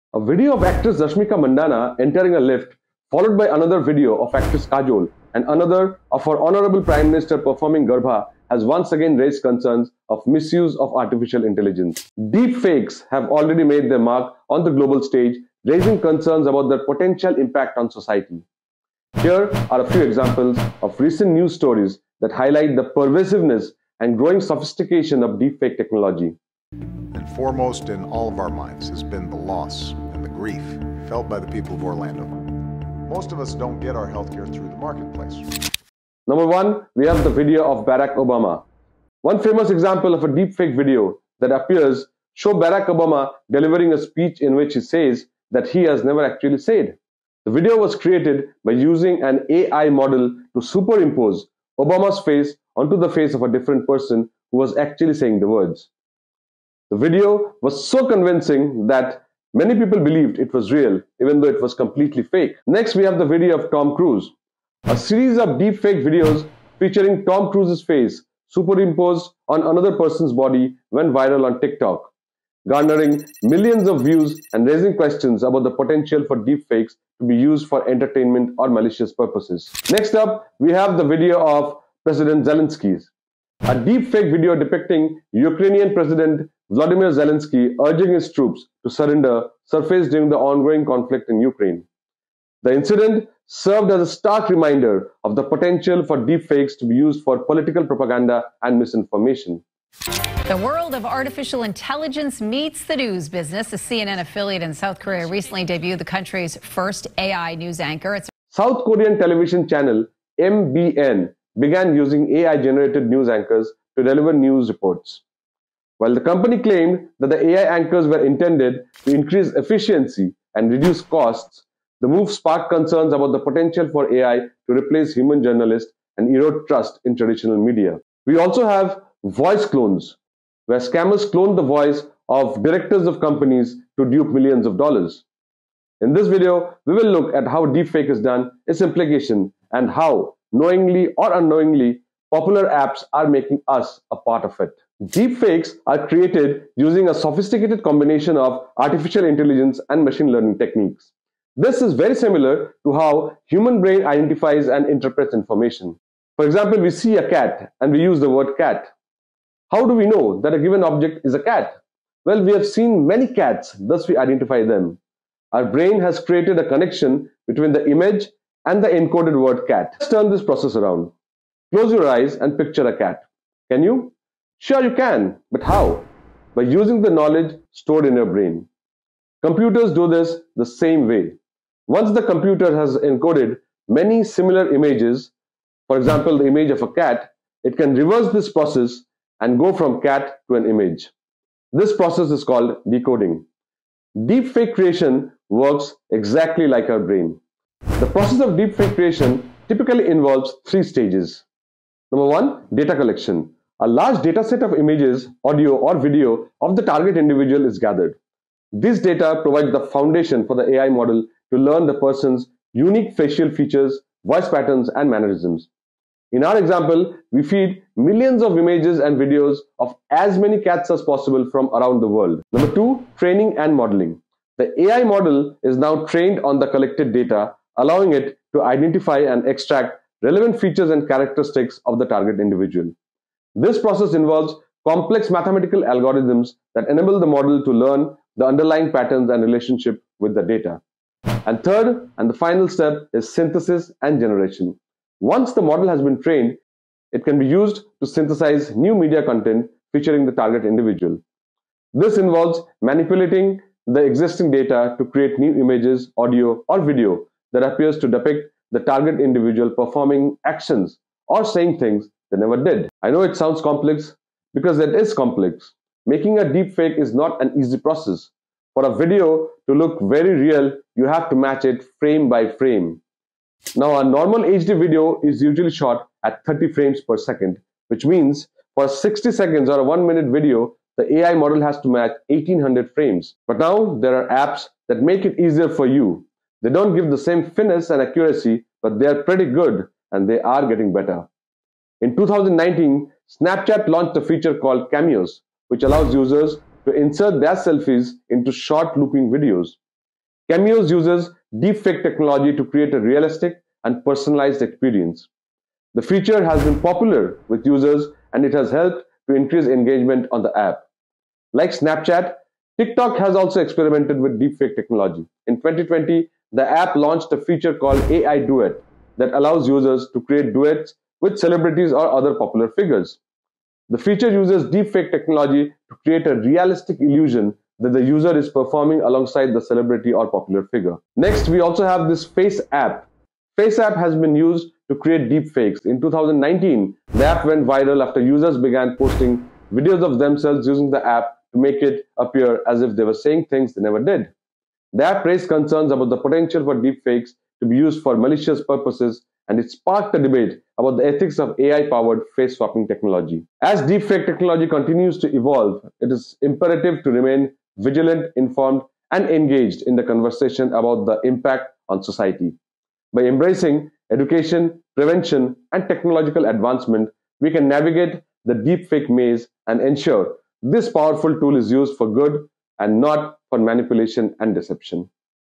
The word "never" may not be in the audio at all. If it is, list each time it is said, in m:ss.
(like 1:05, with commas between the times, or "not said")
0:46, 4:22, 5:43.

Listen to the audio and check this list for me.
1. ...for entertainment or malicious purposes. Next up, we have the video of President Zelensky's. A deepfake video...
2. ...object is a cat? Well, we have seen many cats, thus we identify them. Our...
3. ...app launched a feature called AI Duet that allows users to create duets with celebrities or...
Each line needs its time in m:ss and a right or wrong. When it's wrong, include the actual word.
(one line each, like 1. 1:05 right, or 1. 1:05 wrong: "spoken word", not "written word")
1. 1:17 right
2. 2:40 right
3. 5:16 right.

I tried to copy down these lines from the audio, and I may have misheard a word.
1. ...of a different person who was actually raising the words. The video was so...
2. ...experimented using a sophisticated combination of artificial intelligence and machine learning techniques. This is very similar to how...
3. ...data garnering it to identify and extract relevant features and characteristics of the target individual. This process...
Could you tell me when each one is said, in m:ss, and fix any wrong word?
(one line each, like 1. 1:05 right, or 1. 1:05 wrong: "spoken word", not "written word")
1. 0:53 wrong: "saying", not "raising"
2. 2:26 wrong: "created", not "experimented"
3. 3:47 wrong: "allowing", not "garnering".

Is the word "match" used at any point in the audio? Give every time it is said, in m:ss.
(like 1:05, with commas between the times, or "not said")
4:31, 4:41.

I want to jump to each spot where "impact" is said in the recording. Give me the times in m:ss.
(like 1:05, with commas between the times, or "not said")
0:17, 6:01.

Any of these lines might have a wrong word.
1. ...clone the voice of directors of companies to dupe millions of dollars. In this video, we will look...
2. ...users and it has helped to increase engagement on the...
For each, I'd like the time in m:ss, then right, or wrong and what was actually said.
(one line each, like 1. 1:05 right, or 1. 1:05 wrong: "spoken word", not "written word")
1. 2:11 right
2. 5:07 right.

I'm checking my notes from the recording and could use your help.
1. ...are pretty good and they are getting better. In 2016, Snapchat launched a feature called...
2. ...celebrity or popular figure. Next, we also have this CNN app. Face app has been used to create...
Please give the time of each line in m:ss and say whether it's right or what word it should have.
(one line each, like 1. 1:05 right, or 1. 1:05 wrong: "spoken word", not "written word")
1. 4:49 wrong: "2019", not "2016"
2. 5:29 wrong: "Face", not "CNN".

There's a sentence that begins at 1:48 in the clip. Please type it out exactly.
It's South Korean television channel MBN began using AI generated news anchors to deliver news reports.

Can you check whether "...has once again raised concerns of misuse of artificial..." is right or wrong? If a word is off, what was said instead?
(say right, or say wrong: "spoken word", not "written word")
right.